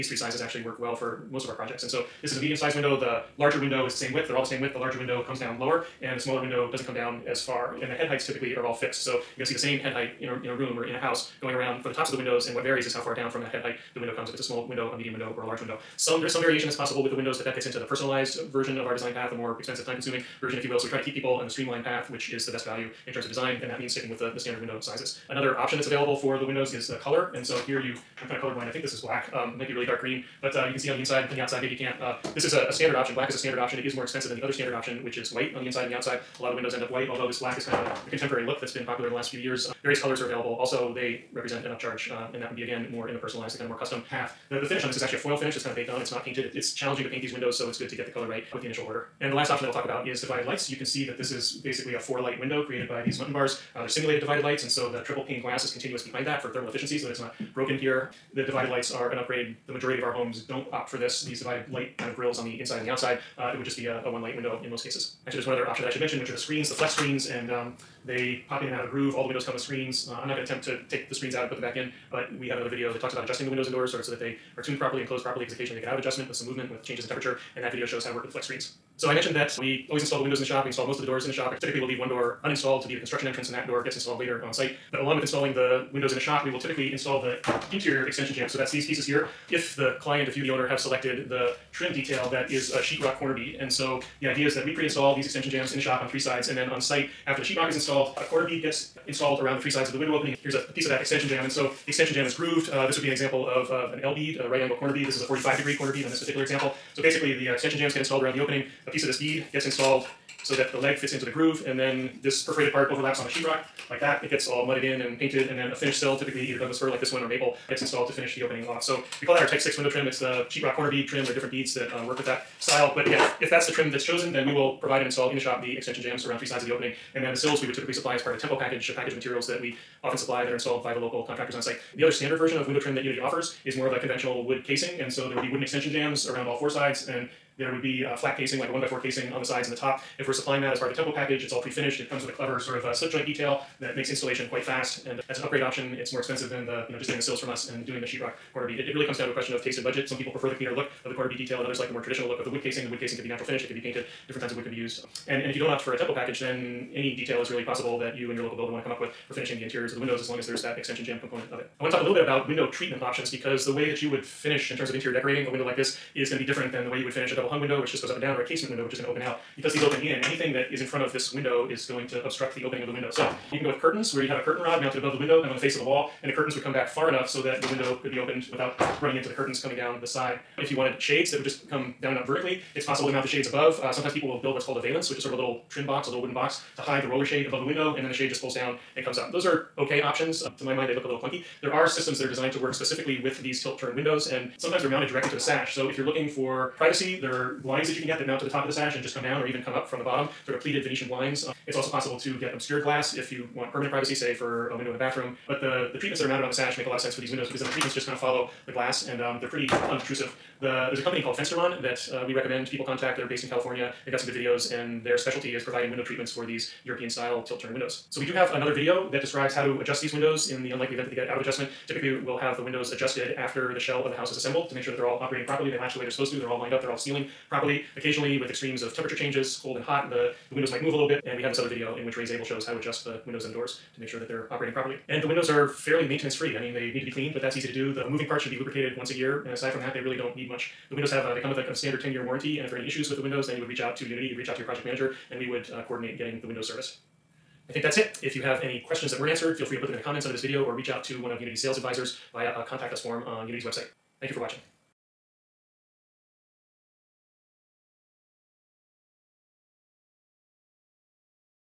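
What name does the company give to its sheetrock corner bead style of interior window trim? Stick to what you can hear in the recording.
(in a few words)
Type 6.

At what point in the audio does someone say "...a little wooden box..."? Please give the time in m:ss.
3:06.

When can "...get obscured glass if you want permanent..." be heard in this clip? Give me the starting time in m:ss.
3:22.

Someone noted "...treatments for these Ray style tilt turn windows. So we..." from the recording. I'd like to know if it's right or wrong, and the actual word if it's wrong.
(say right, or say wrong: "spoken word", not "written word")
wrong: "European", not "Ray".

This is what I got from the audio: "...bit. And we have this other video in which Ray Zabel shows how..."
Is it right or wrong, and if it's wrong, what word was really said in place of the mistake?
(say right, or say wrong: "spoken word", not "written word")
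right.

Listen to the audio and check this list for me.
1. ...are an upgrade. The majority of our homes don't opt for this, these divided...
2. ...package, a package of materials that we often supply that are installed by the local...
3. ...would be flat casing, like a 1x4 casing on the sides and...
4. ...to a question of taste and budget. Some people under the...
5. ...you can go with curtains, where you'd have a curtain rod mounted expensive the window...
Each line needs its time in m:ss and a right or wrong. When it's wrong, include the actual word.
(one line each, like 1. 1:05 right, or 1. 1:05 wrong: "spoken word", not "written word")
1. 0:58 right
2. 2:08 right
3. 2:17 right
4. 2:29 wrong: "prefer", not "under"
5. 2:53 wrong: "above", not "expensive".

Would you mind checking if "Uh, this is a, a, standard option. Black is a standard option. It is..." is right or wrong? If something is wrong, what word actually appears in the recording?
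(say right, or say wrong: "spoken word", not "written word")
right.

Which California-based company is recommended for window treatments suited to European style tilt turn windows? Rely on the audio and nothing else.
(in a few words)
Fensterlon.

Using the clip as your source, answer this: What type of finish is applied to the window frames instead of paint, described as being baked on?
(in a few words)
Foil finish.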